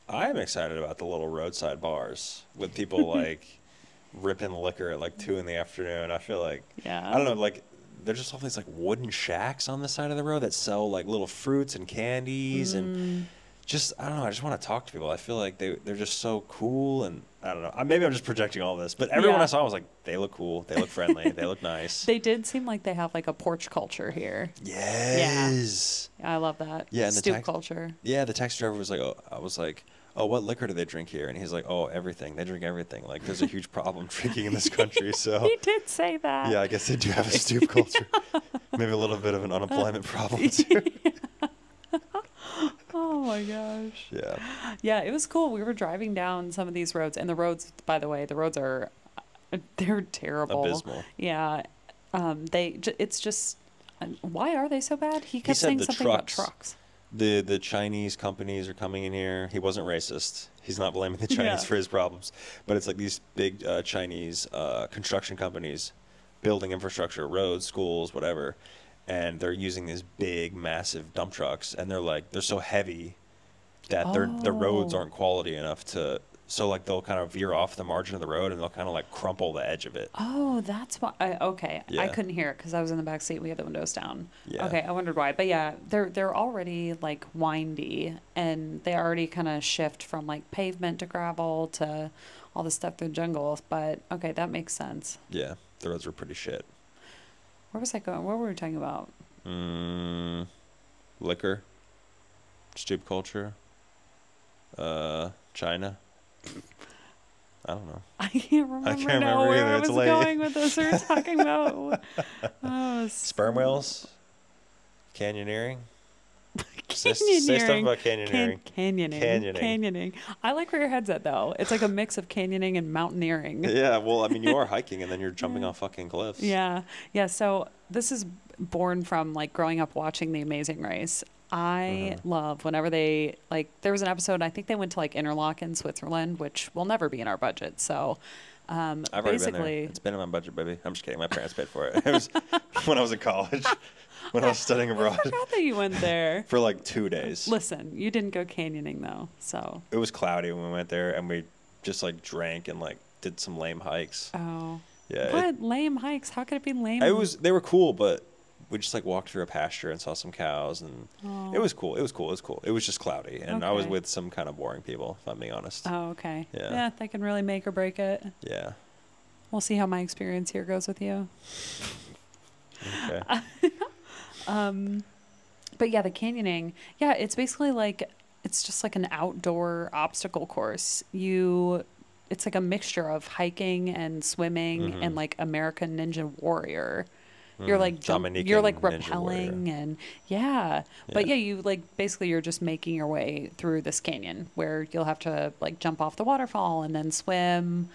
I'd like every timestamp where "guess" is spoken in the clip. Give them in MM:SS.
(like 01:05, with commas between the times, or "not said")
00:36.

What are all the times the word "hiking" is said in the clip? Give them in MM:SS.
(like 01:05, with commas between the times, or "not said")
02:04, 03:03.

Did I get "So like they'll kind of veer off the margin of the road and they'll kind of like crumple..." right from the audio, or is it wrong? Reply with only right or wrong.
right.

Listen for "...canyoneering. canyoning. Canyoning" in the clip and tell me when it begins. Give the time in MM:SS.
01:58.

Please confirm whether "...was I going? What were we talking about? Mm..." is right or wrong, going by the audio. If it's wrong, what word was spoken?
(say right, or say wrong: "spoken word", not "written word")
right.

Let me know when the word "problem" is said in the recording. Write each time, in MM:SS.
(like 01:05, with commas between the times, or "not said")
00:33, 00:40, 01:01.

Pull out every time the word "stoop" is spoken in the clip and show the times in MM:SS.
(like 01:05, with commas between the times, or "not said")
00:27, 00:37, 01:42.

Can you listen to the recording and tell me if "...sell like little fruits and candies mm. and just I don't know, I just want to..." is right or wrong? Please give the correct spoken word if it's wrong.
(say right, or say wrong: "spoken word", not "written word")
right.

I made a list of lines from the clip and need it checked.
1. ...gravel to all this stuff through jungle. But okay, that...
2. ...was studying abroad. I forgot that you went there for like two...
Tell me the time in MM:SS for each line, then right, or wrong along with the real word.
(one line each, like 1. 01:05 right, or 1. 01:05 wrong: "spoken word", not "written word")
1. 01:31 right
2. 02:24 right.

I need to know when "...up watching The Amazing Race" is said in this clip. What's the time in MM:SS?
02:09.